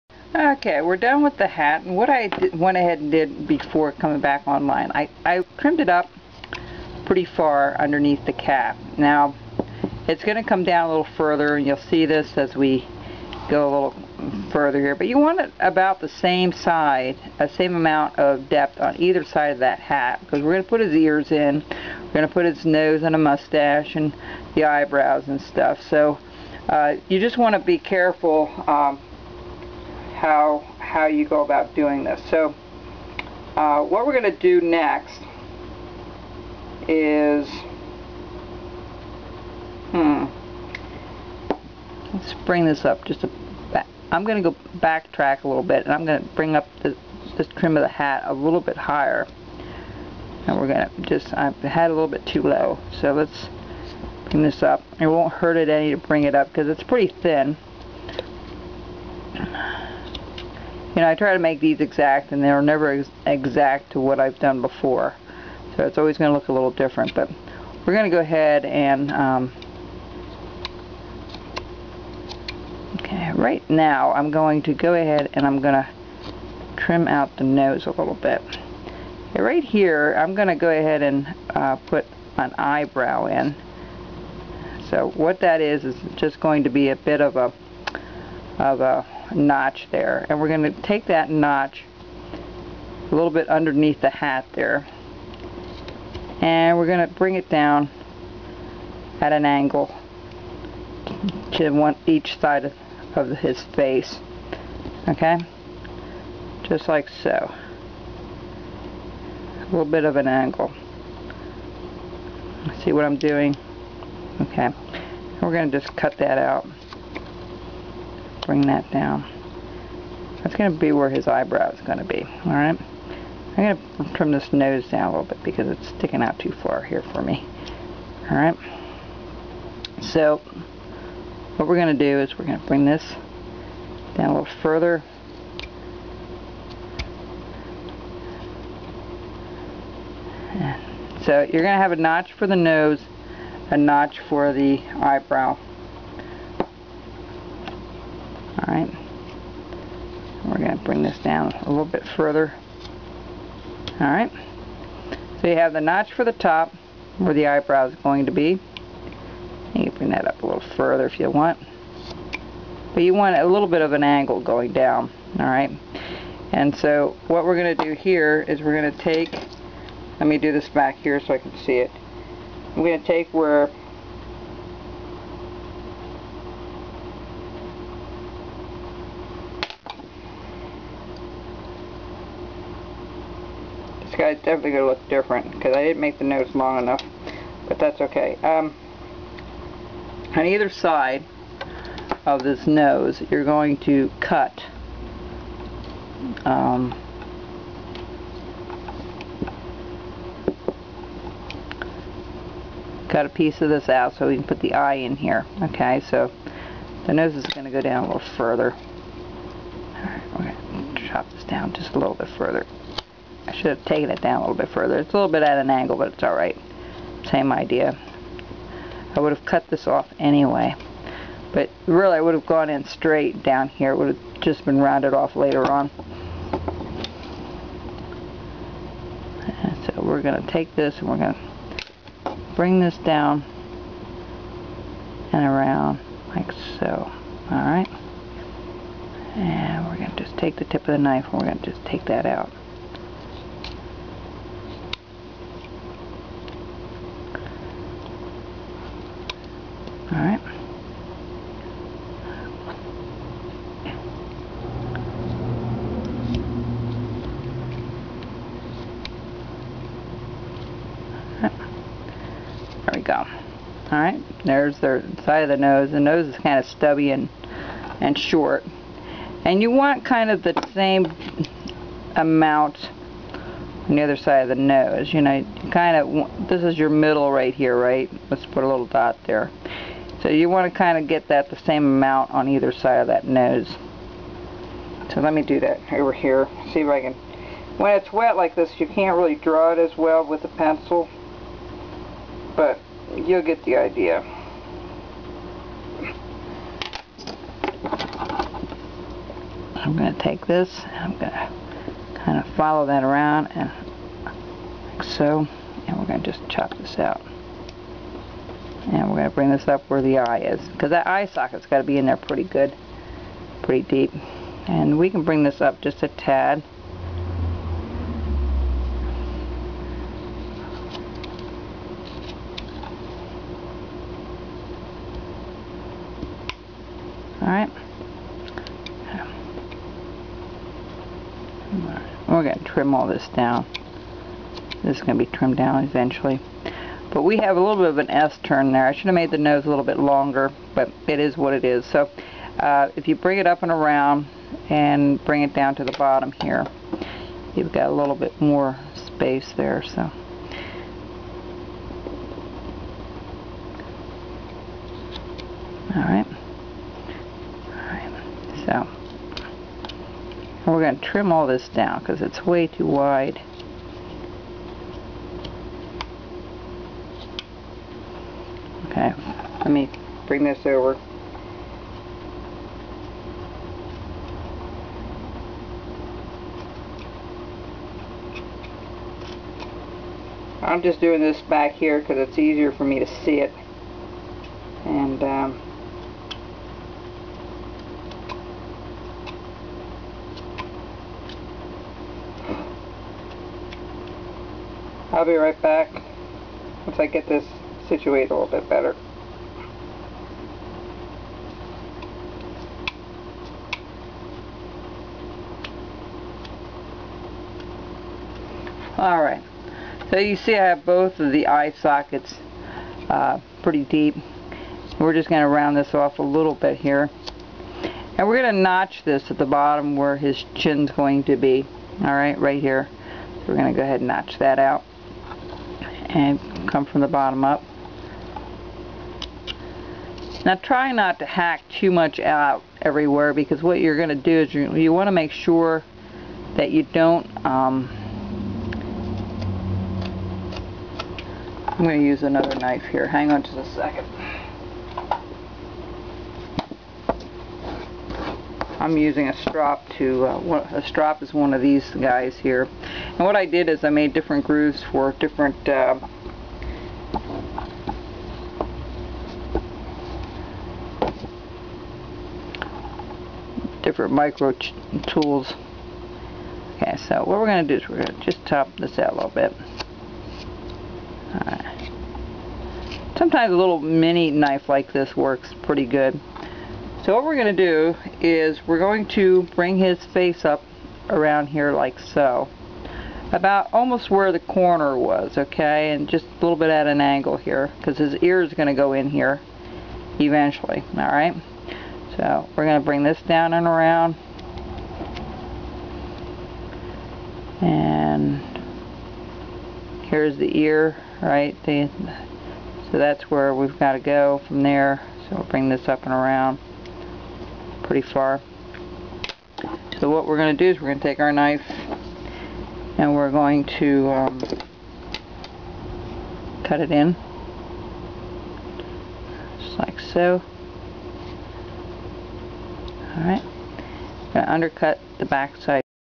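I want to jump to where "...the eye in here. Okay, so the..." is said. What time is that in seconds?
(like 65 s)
204 s.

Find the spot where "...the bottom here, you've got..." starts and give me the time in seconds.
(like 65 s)
345 s.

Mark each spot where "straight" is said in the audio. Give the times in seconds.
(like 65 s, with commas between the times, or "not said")
222 s.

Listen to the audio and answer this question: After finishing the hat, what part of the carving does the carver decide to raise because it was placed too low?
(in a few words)
the trim of the hat.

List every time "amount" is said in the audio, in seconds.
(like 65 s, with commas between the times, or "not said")
17 s, 272 s, 281 s.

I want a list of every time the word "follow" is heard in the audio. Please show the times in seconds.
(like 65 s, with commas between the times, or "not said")
302 s.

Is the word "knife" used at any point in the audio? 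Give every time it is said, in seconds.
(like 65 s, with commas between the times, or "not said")
240 s, 442 s, 474 s, 511 s.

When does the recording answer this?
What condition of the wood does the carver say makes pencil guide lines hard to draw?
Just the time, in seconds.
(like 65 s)
287 s.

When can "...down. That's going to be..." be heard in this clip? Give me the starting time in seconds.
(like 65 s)
118 s.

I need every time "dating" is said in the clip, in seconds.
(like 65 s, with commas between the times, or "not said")
not said.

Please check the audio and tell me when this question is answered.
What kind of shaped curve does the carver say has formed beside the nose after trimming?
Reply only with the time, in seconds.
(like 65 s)
338 s.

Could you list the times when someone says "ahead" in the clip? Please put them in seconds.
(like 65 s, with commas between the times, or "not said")
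2 s, 68 s, 74 s, 80 s, 423 s.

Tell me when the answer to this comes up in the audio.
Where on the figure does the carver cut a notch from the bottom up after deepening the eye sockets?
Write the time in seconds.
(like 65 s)
420 s.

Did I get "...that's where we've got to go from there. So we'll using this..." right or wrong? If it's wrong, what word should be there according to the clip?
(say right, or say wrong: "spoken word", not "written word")
wrong: "bring", not "using".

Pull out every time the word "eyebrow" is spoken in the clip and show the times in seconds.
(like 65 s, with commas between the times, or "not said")
24 s, 82 s, 121 s, 144 s, 157 s.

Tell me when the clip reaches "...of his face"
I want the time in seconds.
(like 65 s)
103 s.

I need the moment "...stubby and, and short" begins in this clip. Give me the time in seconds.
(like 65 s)
266 s.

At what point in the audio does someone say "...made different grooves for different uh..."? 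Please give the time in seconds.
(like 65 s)
453 s.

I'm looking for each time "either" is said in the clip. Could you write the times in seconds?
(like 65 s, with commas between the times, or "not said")
19 s, 190 s, 282 s.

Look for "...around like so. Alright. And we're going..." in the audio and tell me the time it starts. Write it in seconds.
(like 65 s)
235 s.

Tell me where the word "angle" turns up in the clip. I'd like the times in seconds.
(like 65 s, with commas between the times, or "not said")
99 s, 110 s, 164 s, 215 s, 486 s.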